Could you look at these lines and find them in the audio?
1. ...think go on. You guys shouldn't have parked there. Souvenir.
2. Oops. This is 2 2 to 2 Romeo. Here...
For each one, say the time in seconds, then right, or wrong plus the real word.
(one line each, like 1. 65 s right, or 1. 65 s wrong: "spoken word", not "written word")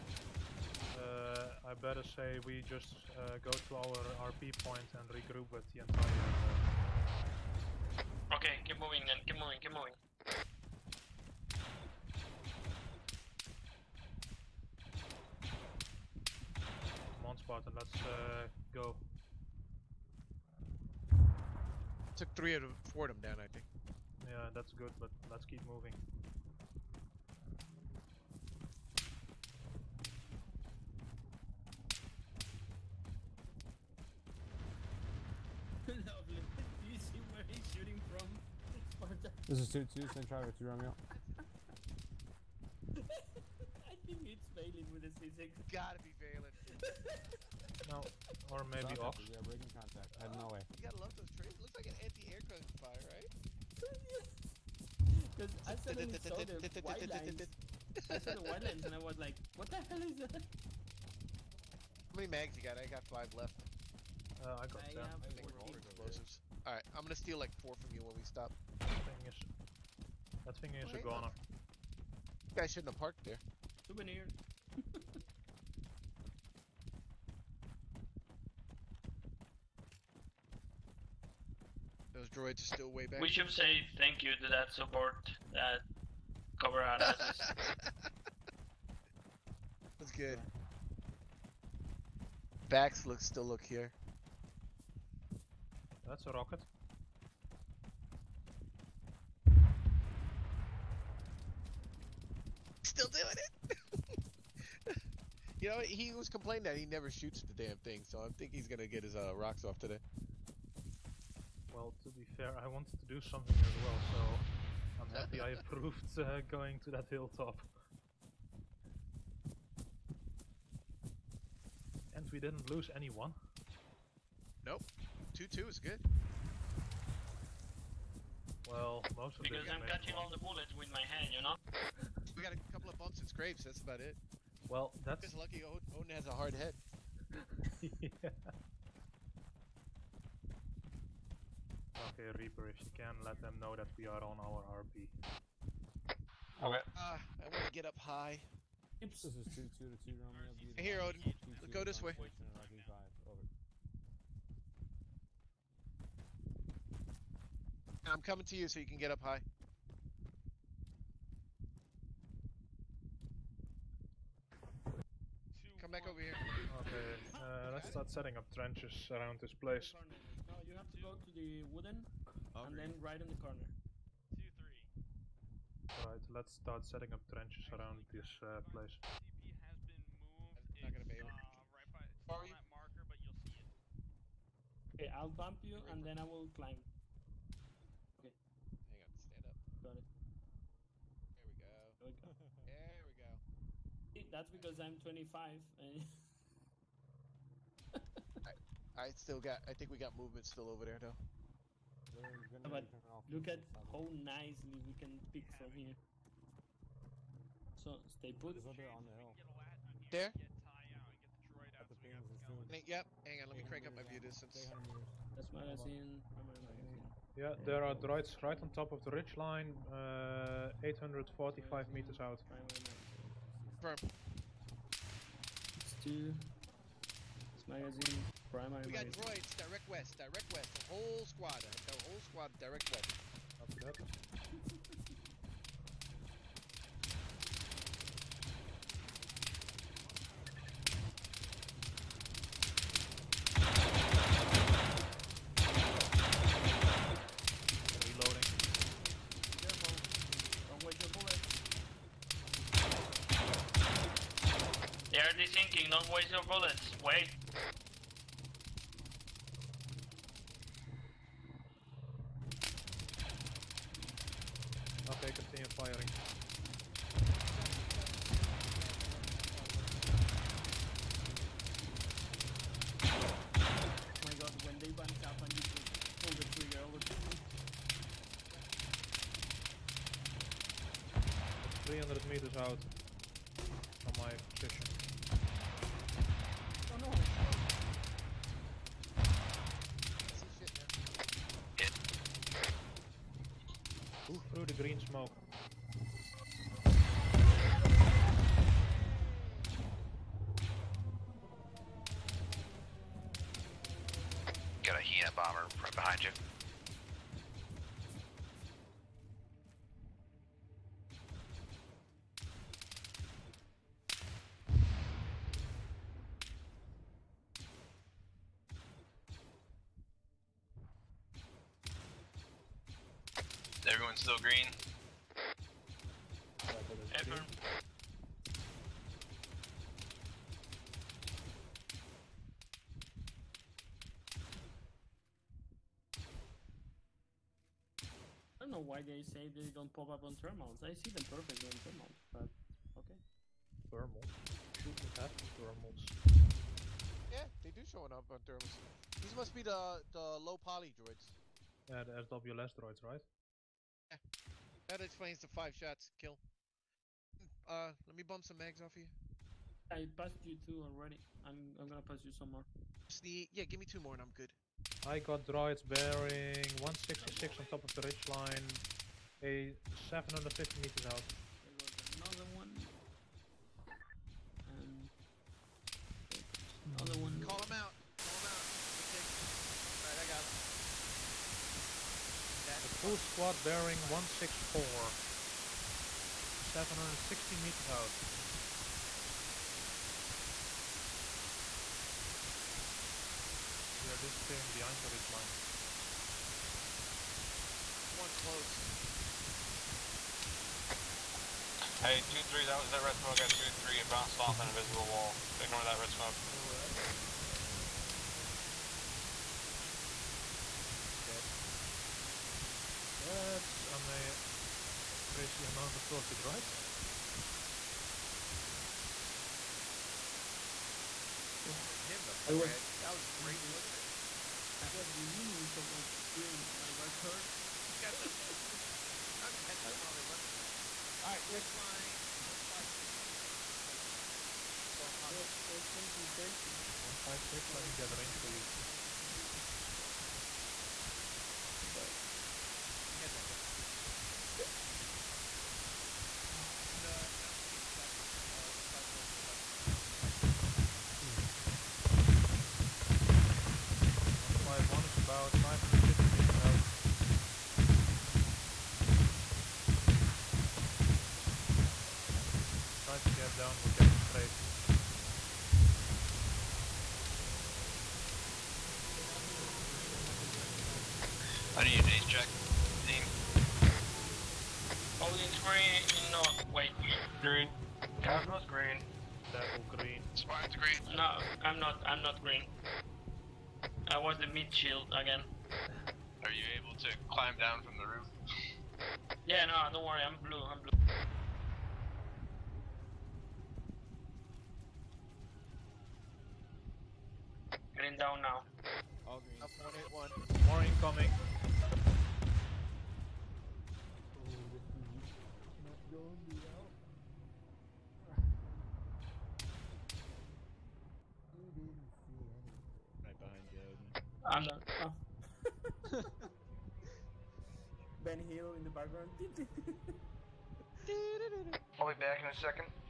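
1. 70 s right
2. 149 s right.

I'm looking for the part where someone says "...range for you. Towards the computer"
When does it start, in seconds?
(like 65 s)
438 s.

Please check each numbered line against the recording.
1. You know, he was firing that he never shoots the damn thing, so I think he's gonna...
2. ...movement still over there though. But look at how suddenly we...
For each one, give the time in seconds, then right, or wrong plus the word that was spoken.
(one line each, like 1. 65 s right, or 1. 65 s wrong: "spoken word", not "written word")
1. 105 s wrong: "complaining", not "firing"
2. 200 s wrong: "nicely", not "suddenly".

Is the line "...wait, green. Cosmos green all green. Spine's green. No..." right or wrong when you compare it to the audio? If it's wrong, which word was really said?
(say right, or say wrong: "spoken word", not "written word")
right.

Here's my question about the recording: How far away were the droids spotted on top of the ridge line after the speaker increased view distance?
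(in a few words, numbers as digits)
845 meters.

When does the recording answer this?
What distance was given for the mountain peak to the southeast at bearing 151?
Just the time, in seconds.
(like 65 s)
455 s.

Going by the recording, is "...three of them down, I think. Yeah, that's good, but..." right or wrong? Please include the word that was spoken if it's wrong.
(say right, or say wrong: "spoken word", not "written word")
wrong: "four", not "three".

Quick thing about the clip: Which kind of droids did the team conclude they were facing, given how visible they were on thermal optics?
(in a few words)
SWLS droids.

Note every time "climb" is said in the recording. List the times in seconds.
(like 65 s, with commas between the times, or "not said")
186 s, 487 s.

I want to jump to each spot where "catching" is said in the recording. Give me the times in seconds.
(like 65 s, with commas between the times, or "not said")
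129 s, 429 s.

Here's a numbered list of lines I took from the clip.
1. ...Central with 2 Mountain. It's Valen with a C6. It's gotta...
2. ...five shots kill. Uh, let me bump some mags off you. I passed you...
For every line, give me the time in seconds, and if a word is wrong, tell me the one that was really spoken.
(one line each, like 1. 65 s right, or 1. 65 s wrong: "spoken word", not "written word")
1. 40 s wrong: "Romeo", not "Mountain"
2. 355 s right.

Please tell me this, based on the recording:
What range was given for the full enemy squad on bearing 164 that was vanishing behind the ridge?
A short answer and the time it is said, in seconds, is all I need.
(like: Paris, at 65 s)
760 meters, at 386 s.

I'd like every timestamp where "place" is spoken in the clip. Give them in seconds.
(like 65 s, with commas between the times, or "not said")
169 s, 178 s.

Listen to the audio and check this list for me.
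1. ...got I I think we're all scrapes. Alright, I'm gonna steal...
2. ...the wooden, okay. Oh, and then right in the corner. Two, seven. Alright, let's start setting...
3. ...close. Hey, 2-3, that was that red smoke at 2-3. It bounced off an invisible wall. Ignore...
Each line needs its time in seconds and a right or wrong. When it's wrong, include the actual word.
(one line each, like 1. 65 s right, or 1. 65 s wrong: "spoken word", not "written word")
1. 64 s wrong: "explosives", not "scrapes"
2. 171 s wrong: "three", not "seven"
3. 398 s right.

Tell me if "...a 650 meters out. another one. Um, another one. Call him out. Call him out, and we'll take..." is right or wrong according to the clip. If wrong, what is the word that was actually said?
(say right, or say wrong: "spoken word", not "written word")
wrong: "750", not "650".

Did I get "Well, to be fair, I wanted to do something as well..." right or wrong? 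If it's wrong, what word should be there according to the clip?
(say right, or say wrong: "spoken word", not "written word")
right.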